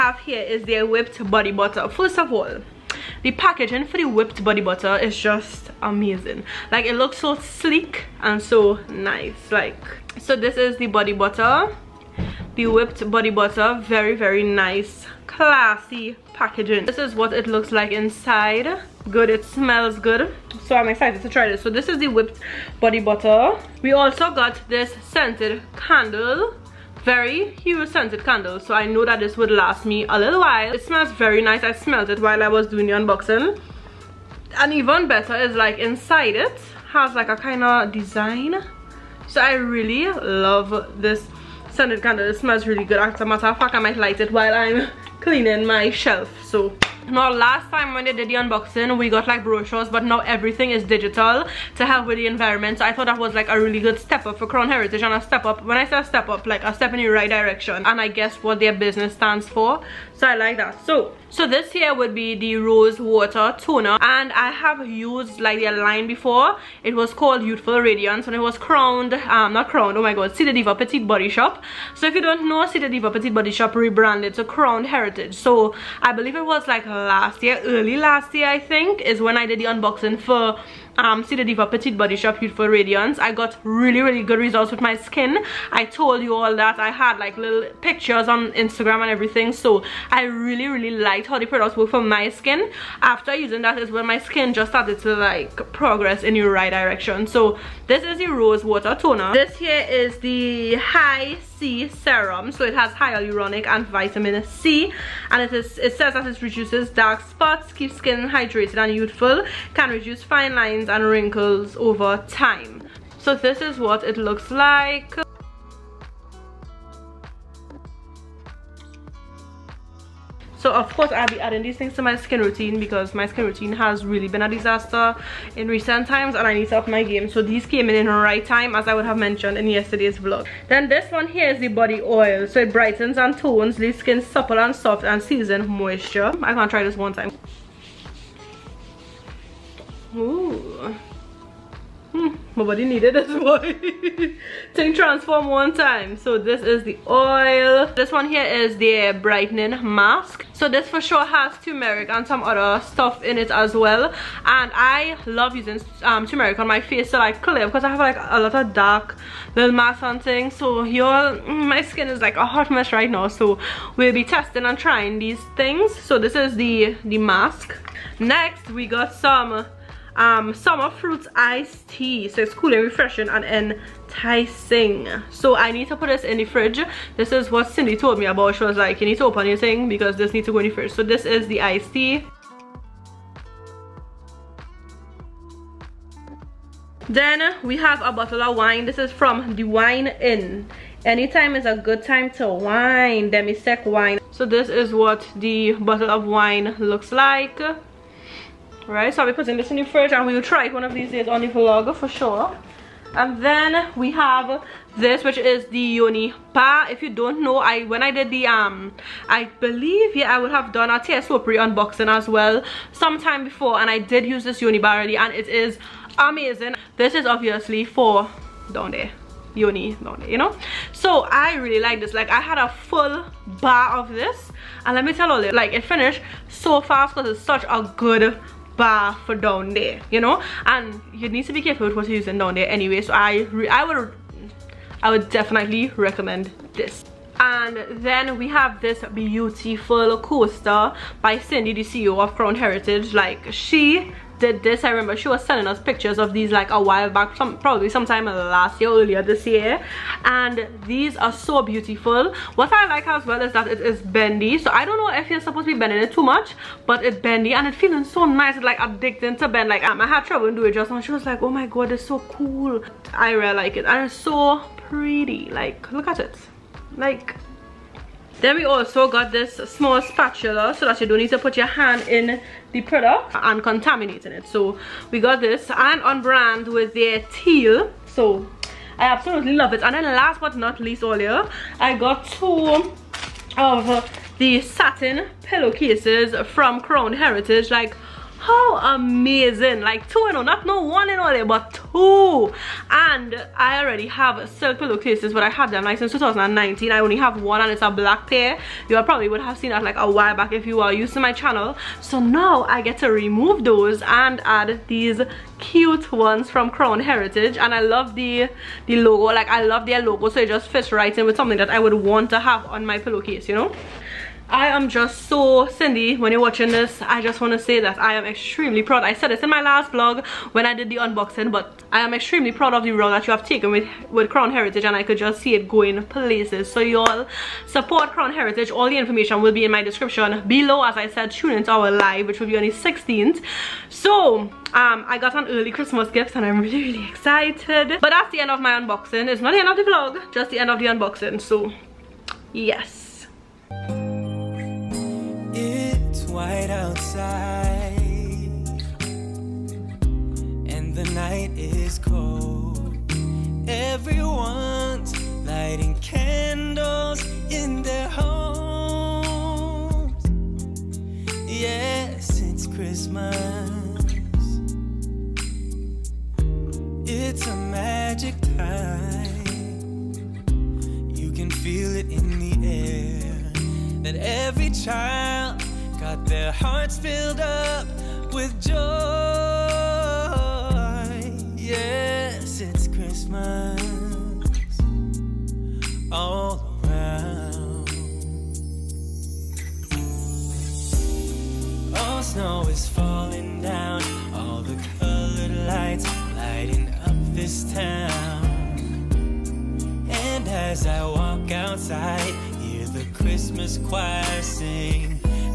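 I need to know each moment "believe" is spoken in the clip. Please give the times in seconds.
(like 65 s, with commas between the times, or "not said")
76 s, 209 s.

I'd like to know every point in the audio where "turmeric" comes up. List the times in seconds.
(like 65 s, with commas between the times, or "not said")
151 s, 156 s.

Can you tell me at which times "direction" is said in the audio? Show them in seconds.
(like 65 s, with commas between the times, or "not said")
57 s, 96 s.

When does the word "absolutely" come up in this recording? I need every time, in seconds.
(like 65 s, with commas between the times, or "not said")
279 s.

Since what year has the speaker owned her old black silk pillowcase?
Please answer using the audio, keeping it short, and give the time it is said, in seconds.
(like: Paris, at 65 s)
2019, at 296 s.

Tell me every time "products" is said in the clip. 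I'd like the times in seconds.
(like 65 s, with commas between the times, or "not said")
91 s, 272 s.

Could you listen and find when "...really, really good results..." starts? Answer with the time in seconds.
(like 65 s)
83 s.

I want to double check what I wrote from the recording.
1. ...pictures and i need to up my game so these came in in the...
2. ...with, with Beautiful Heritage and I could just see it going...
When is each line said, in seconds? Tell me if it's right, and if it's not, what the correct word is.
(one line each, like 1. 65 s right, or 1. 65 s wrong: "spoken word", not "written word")
1. 126 s wrong: "times", not "pictures"
2. 323 s wrong: "Crown", not "Beautiful".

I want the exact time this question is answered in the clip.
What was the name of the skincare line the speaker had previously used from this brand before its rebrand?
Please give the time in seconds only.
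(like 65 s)
67 s.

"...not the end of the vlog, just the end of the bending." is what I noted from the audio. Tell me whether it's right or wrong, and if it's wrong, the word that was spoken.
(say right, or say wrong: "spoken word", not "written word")
wrong: "unboxing", not "bending".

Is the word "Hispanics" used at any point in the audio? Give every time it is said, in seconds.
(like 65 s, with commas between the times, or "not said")
not said.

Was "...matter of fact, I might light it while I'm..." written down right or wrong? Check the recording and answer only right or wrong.
right.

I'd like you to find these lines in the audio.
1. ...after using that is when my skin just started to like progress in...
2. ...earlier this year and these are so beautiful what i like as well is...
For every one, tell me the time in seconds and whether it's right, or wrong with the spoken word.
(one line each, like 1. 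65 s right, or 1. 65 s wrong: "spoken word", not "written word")
1. 93 s right
2. 248 s right.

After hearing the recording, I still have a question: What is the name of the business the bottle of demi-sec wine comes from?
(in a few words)
The Wine Inn.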